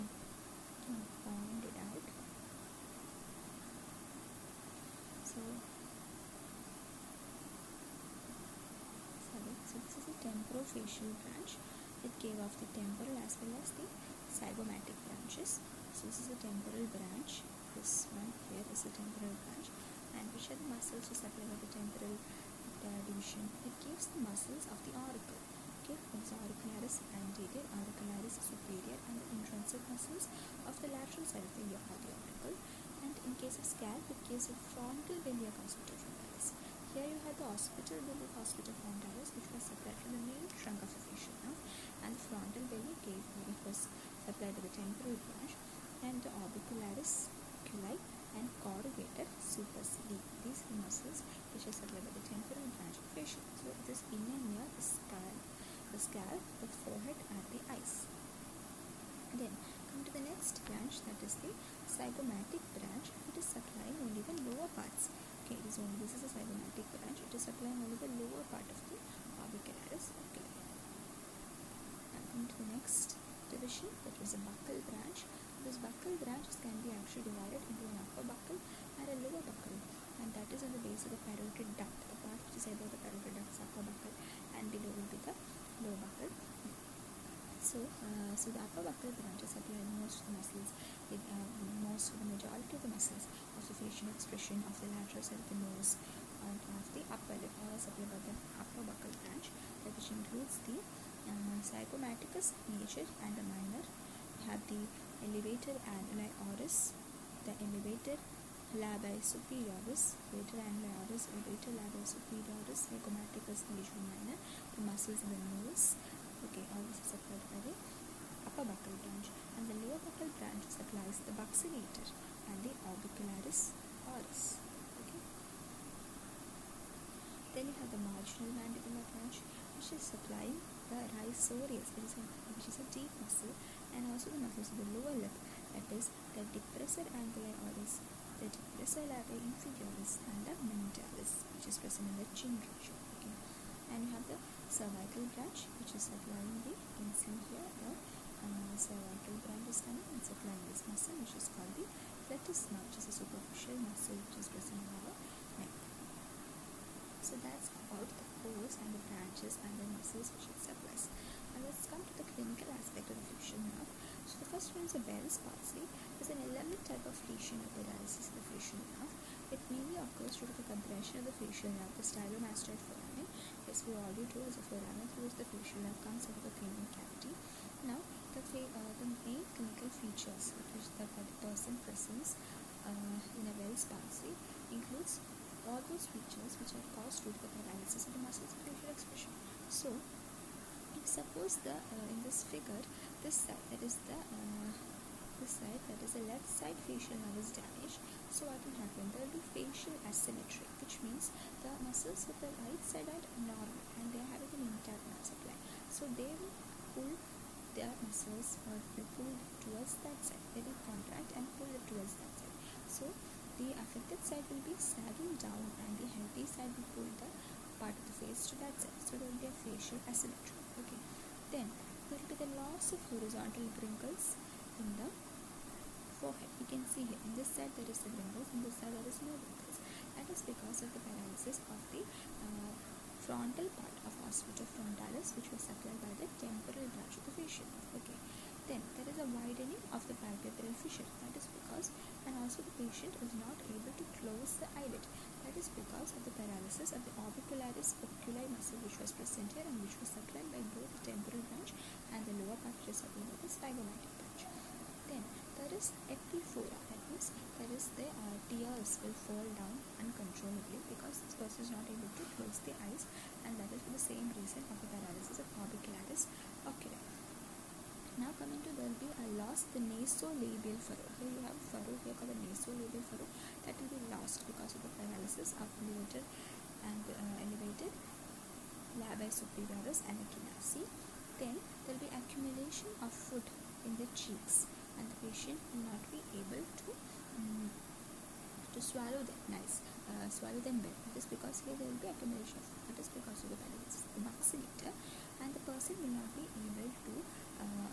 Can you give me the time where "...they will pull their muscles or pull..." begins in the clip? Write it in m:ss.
3:26.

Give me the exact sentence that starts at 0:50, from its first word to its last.
These are muscles which are supplied by the temporal branch of fascia.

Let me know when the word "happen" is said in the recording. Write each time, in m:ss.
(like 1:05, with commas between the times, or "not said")
3:18.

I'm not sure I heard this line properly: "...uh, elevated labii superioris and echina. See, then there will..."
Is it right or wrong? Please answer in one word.
right.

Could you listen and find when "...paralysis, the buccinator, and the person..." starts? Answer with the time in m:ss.
4:53.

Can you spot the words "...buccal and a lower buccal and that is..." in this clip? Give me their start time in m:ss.
1:18.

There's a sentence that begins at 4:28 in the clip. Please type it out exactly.
Now coming to there will be a lost the nasolabial furrow.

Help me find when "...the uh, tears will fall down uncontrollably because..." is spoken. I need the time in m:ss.
4:17.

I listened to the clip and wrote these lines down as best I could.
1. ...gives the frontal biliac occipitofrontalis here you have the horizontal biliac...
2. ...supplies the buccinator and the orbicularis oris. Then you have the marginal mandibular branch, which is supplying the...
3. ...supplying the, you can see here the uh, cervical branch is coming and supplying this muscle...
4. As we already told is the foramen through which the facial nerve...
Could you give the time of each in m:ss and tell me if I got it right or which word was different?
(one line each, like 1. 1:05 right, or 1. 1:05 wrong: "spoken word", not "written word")
1. 0:34 wrong: "hospital", not "horizontal"
2. 2:00 right
3. 2:26 right
4. 2:53 right.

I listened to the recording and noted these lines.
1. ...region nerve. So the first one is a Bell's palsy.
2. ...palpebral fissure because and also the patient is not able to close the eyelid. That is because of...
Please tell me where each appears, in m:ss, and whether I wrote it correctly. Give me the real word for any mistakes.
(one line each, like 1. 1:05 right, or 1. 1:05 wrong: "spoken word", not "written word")
1. 2:43 wrong: "affliction", not "region"
2. 4:00 right.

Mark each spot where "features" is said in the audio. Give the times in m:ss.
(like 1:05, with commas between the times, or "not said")
2:59, 3:06.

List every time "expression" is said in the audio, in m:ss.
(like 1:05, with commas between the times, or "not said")
1:34, 3:08.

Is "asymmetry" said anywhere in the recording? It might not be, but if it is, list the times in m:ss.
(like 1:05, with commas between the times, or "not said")
3:20, 3:40.